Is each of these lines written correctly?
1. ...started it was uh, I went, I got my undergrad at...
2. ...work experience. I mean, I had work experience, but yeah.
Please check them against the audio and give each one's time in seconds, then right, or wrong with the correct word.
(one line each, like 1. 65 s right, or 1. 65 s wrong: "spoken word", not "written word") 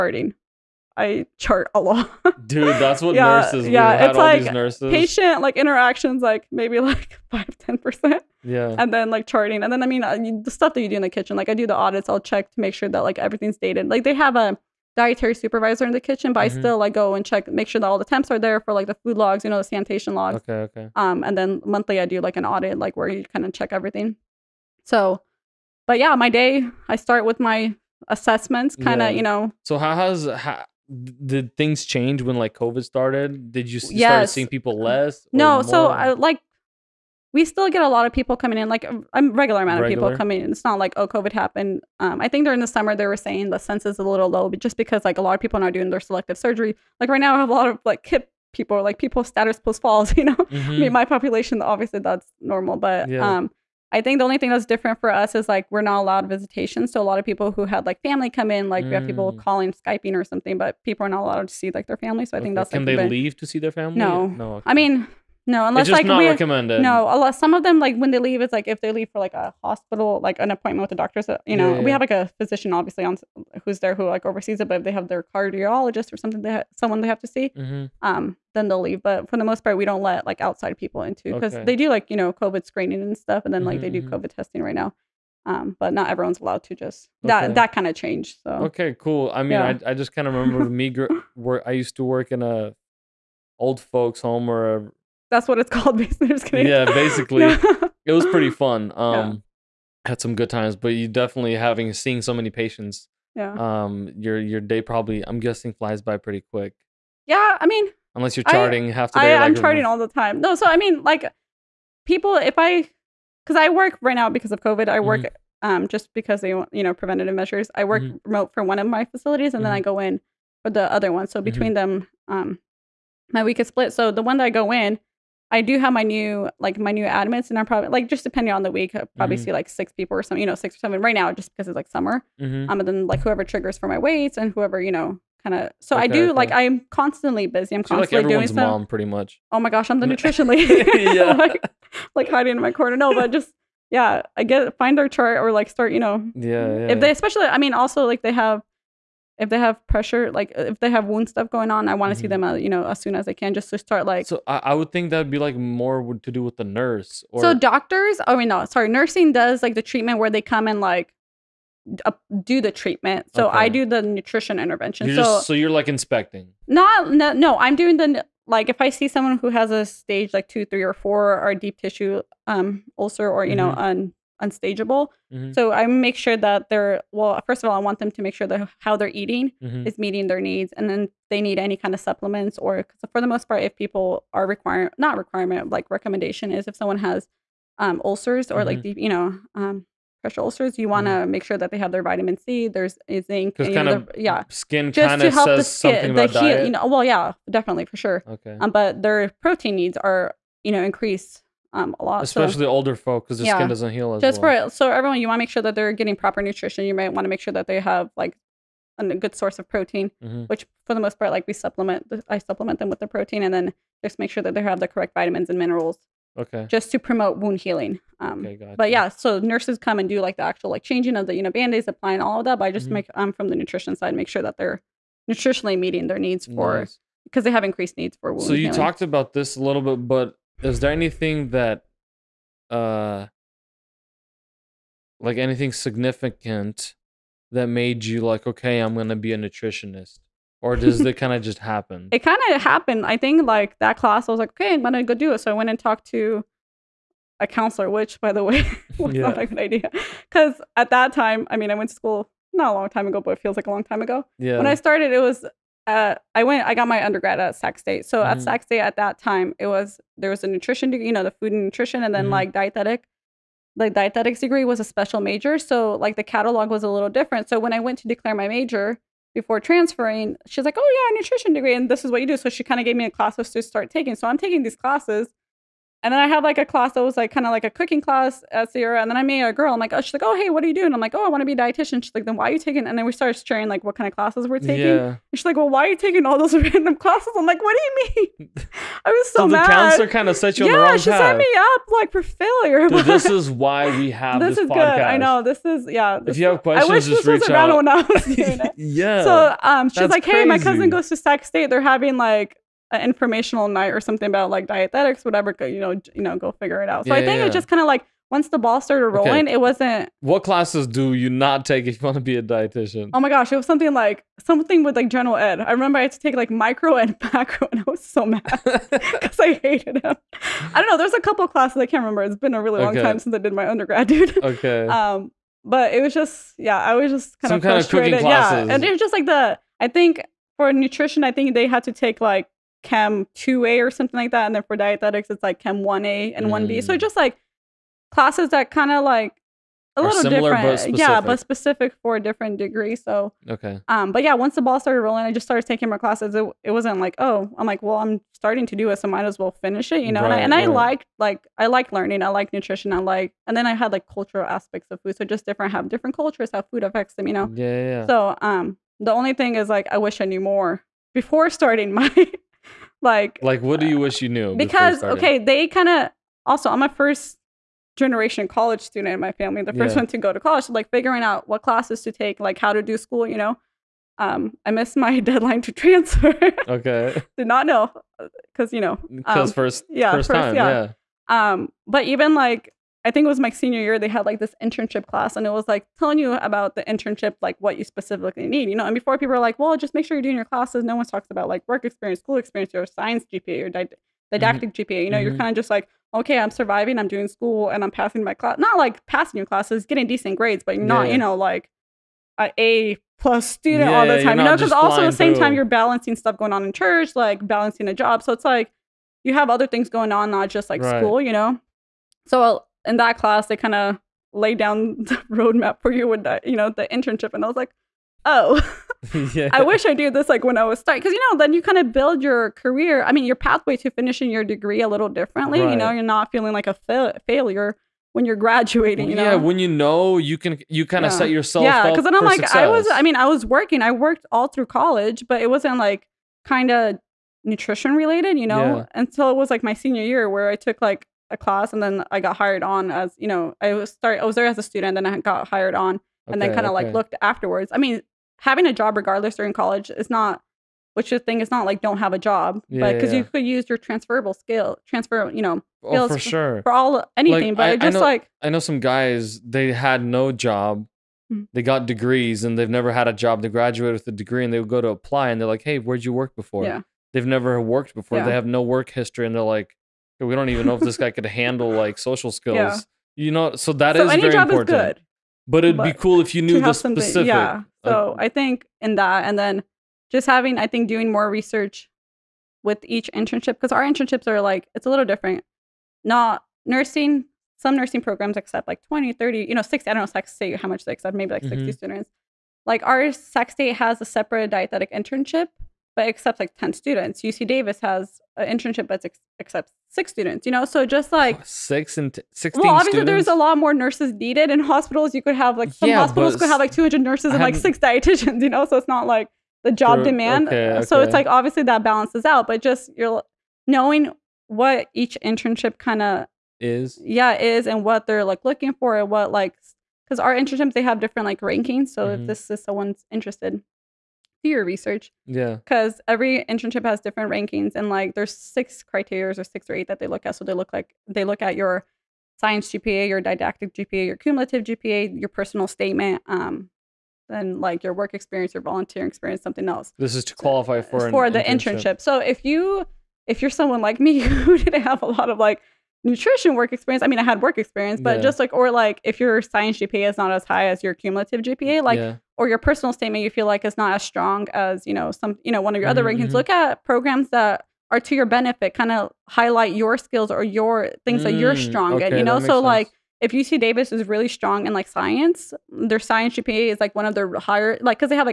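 1. 254 s right
2. 546 s right.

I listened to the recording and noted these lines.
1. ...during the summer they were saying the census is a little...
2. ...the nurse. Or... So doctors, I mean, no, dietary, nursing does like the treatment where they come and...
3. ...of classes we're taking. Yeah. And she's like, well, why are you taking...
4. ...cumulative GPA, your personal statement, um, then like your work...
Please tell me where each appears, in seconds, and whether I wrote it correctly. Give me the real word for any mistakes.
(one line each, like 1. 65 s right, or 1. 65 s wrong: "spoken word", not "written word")
1. 42 s right
2. 156 s wrong: "sorry", not "dietary"
3. 284 s right
4. 534 s right.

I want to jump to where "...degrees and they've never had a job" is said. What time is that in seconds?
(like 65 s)
461 s.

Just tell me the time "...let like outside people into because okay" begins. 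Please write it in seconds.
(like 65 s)
80 s.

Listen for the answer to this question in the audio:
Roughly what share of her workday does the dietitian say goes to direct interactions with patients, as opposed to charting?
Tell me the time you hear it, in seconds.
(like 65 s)
7 s.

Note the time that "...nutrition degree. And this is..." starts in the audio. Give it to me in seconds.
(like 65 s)
271 s.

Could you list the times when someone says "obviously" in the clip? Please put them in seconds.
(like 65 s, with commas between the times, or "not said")
51 s, 72 s, 502 s, 511 s.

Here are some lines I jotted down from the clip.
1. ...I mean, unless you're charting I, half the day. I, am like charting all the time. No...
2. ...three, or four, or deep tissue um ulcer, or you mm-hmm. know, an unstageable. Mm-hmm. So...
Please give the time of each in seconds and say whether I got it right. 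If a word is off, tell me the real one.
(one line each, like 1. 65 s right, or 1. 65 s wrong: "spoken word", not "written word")
1. 107 s right
2. 170 s right.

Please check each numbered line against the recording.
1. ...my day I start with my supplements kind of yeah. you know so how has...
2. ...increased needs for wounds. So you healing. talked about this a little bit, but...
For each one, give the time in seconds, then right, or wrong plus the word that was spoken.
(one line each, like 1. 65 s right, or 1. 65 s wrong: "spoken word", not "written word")
1. 26 s wrong: "assessments", not "supplements"
2. 227 s right.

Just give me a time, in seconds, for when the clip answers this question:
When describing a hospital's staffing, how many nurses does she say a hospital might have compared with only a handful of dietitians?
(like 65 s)
506 s.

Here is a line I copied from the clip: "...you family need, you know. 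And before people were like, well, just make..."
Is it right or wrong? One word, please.
wrong.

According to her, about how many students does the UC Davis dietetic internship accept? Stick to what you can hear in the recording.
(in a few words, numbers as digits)
6.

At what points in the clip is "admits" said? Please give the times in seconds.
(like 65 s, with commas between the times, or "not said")
127 s.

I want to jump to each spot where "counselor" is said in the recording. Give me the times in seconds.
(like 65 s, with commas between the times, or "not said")
247 s, 289 s.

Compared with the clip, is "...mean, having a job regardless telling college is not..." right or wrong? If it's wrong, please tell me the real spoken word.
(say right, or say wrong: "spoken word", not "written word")
wrong: "during", not "telling".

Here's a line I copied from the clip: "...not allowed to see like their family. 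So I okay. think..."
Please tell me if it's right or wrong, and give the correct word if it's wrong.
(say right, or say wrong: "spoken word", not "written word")
right.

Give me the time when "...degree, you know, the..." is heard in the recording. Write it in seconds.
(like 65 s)
260 s.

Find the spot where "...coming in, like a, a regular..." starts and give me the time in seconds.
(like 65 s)
38 s.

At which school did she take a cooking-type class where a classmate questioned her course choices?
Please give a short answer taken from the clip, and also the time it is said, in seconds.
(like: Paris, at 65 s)
Sierra, at 278 s.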